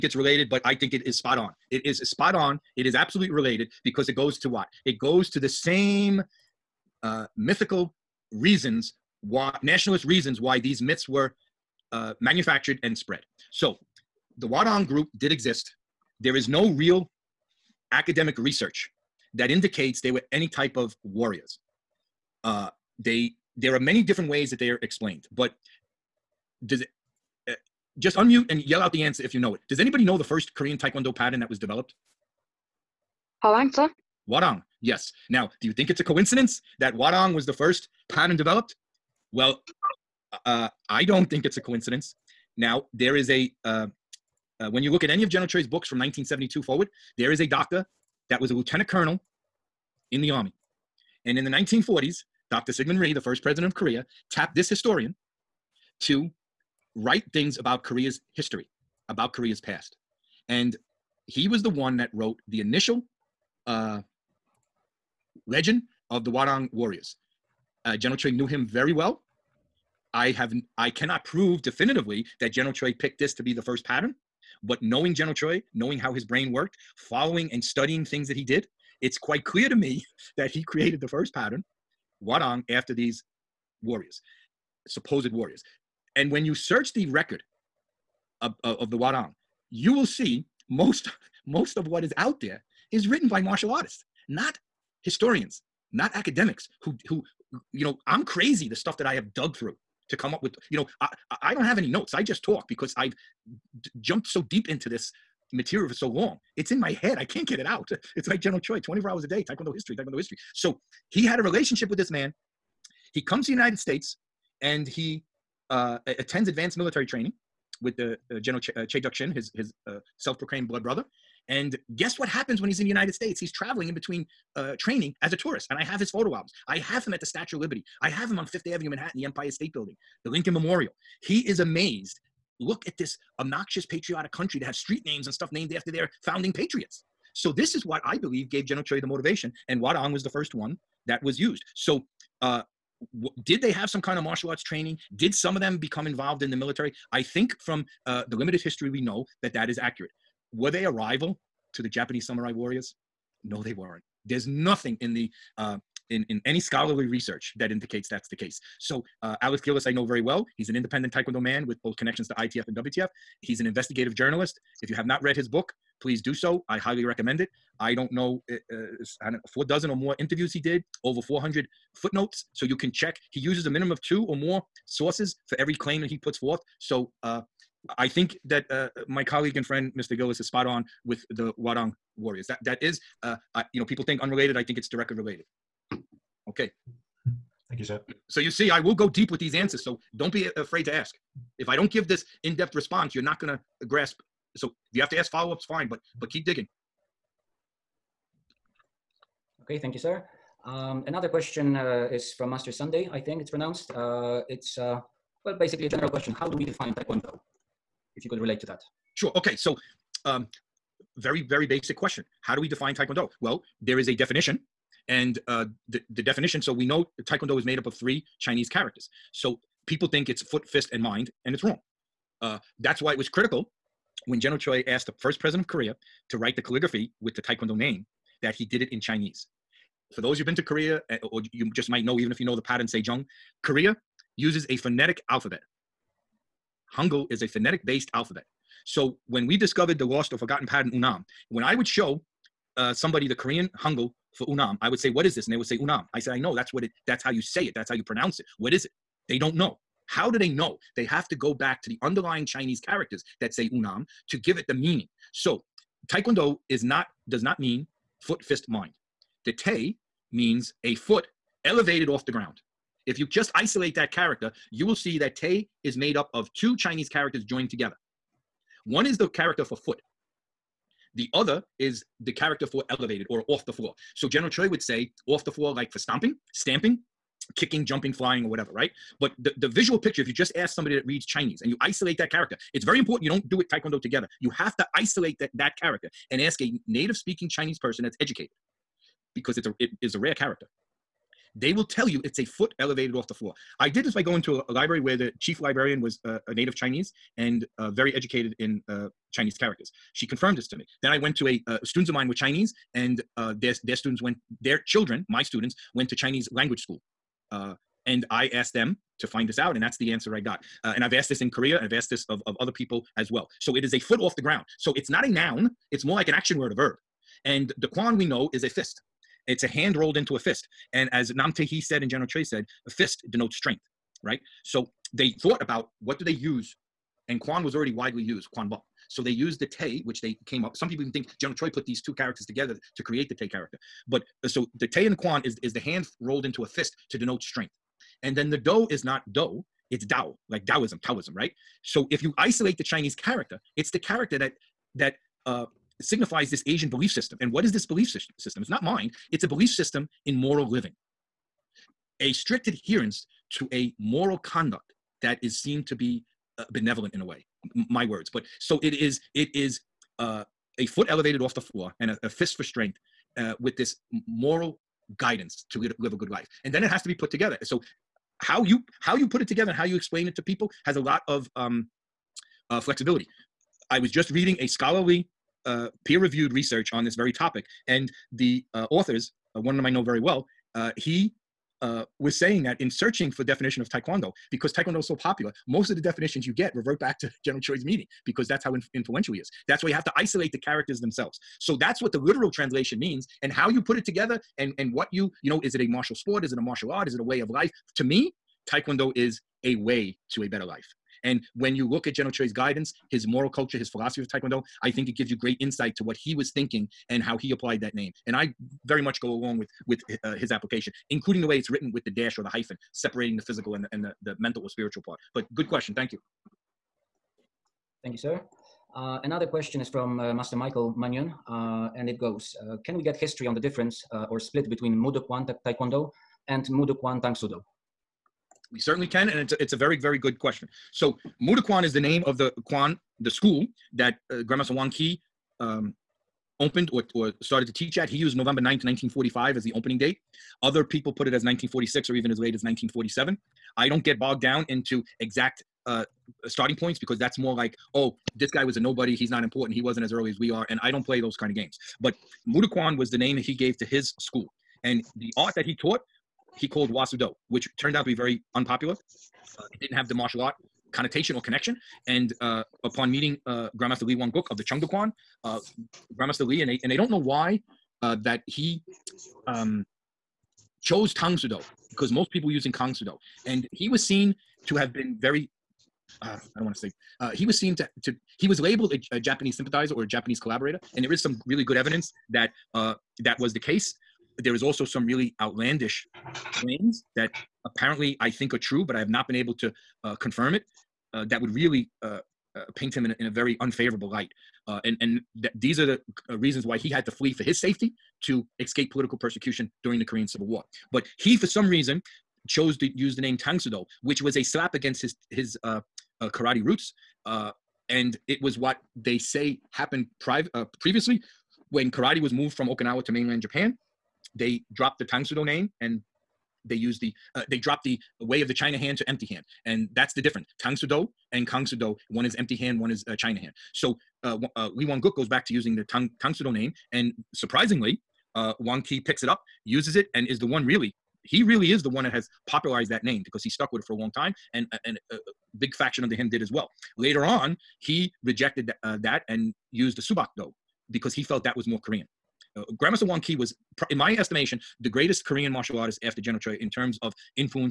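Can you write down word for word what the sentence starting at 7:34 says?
And the art that he taught he called Hwa Soo Do, which turned out to be very unpopular.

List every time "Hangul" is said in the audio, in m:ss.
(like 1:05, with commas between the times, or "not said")
3:56, 4:03.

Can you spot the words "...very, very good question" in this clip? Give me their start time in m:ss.
7:09.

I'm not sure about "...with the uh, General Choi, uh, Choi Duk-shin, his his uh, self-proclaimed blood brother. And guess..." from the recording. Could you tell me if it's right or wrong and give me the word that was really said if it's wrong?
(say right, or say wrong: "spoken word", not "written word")
right.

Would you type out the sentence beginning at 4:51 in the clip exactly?
They will tell you it's a foot elevated off the floor.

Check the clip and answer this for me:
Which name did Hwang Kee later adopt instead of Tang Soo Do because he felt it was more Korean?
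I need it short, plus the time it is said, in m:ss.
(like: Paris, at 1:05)
Subak, at 9:00.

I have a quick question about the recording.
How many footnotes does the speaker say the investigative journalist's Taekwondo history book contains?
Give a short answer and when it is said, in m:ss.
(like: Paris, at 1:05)
Over 400, at 2:51.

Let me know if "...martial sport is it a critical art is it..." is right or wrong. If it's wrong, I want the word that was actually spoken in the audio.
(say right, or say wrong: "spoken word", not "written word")
wrong: "martial", not "critical".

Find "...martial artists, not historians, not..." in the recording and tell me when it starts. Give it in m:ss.
1:33.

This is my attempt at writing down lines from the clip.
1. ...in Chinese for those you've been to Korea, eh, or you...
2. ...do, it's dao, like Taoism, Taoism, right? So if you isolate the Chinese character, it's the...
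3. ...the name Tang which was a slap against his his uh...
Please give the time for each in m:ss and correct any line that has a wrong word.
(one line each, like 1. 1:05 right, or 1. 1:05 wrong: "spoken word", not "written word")
1. 3:48 right
2. 5:39 right
3. 8:23 right.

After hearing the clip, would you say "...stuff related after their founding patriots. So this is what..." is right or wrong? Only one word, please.
wrong.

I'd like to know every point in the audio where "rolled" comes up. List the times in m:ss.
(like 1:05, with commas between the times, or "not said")
5:19, 5:36.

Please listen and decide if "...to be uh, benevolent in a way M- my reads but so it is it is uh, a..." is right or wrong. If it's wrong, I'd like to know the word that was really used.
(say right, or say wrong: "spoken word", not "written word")
wrong: "words", not "reads".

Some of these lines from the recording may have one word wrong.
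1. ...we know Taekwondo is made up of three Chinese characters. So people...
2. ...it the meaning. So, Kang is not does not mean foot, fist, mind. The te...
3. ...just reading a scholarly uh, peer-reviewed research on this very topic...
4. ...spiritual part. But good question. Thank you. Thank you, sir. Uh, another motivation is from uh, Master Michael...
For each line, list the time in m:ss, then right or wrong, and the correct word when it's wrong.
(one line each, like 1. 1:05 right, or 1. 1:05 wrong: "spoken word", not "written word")
1. 3:36 right
2. 4:14 wrong: "Taekwondo", not "Kang"
3. 6:14 right
4. 6:54 wrong: "question", not "motivation".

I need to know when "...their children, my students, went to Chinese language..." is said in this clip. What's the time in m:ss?
5:04.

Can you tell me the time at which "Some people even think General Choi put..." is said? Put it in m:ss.
5:30.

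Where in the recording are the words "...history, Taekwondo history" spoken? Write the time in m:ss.
1:49.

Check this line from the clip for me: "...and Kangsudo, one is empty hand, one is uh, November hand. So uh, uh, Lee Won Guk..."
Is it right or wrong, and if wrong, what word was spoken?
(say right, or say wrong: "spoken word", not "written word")
wrong: "China", not "November".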